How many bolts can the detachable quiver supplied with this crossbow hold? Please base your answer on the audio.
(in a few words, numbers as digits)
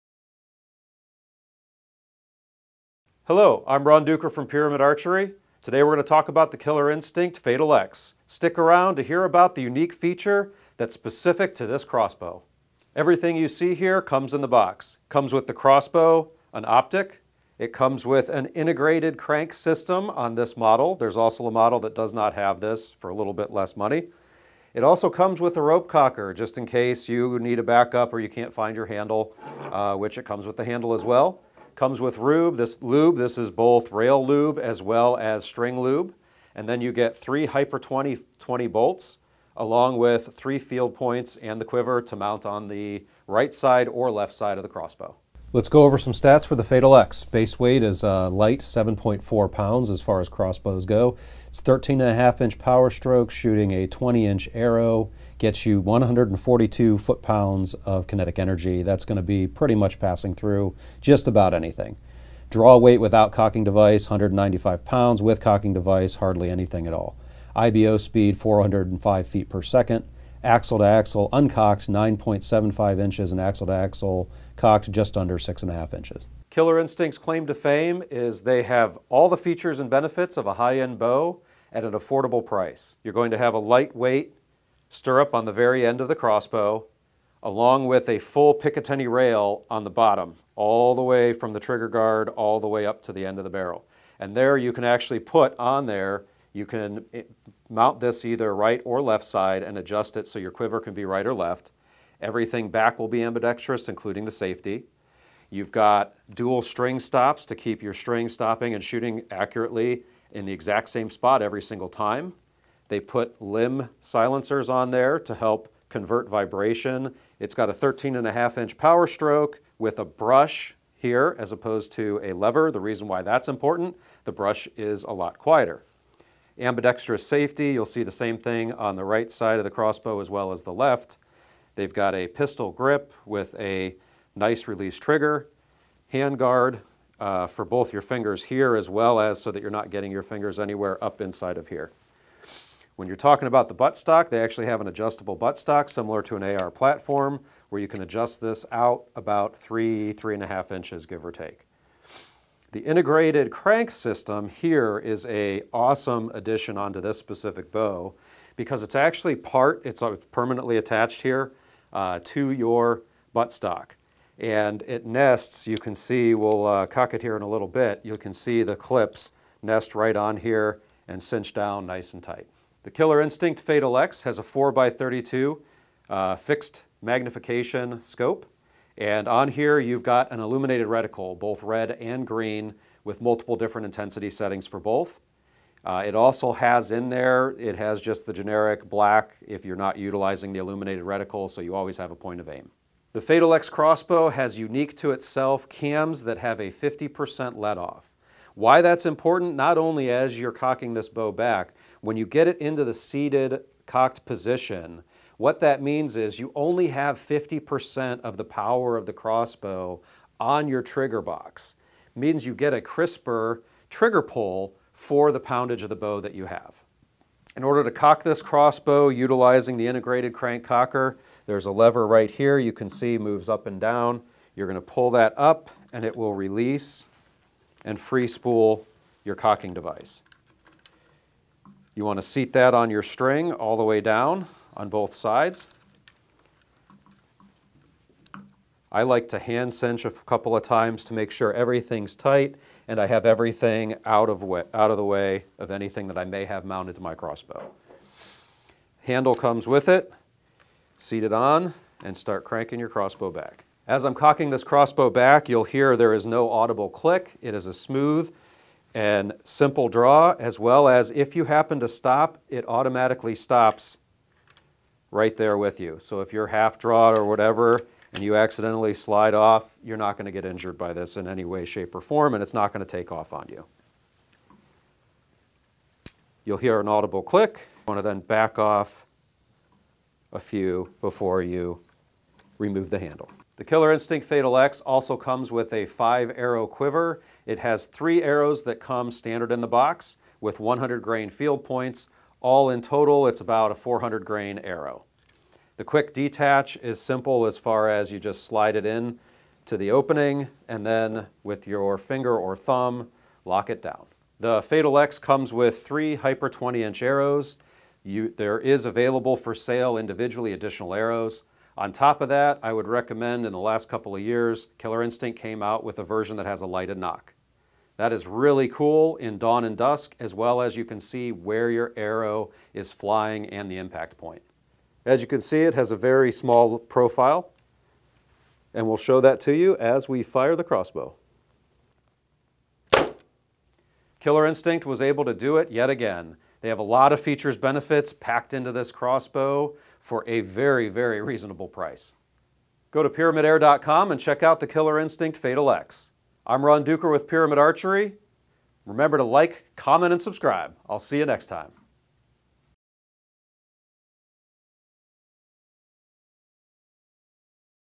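5.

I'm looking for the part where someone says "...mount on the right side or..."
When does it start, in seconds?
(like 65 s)
42 s.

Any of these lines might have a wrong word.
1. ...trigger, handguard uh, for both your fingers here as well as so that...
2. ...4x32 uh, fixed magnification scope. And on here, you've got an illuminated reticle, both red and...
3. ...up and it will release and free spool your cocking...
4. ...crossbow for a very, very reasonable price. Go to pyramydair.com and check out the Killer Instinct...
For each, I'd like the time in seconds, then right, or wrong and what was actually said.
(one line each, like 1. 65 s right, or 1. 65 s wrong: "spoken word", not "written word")
1. 134 s right
2. 174 s right
3. 225 s right
4. 338 s right.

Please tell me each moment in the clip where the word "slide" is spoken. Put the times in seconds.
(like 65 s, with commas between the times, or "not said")
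268 s, 298 s.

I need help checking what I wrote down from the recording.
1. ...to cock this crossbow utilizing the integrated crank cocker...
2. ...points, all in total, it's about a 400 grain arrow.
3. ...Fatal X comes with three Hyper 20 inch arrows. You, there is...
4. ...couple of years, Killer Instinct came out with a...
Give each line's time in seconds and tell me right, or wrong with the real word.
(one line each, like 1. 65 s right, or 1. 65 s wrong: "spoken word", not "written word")
1. 217 s right
2. 291 s right
3. 304 s right
4. 313 s right.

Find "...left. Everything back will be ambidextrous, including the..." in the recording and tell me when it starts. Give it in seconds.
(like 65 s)
101 s.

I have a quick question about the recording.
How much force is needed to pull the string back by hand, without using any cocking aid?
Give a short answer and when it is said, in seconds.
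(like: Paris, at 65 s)
195 pounds, at 64 s.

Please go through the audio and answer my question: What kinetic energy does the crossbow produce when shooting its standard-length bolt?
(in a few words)
142 foot pounds.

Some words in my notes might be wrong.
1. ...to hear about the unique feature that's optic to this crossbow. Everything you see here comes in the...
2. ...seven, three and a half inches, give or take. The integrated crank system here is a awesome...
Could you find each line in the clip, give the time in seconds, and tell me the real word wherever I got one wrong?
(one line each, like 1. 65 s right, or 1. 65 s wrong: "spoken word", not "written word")
1. 8 s wrong: "specific", not "optic"
2. 149 s wrong: "three", not "seven".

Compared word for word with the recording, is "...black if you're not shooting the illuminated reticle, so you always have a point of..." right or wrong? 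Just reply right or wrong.
wrong.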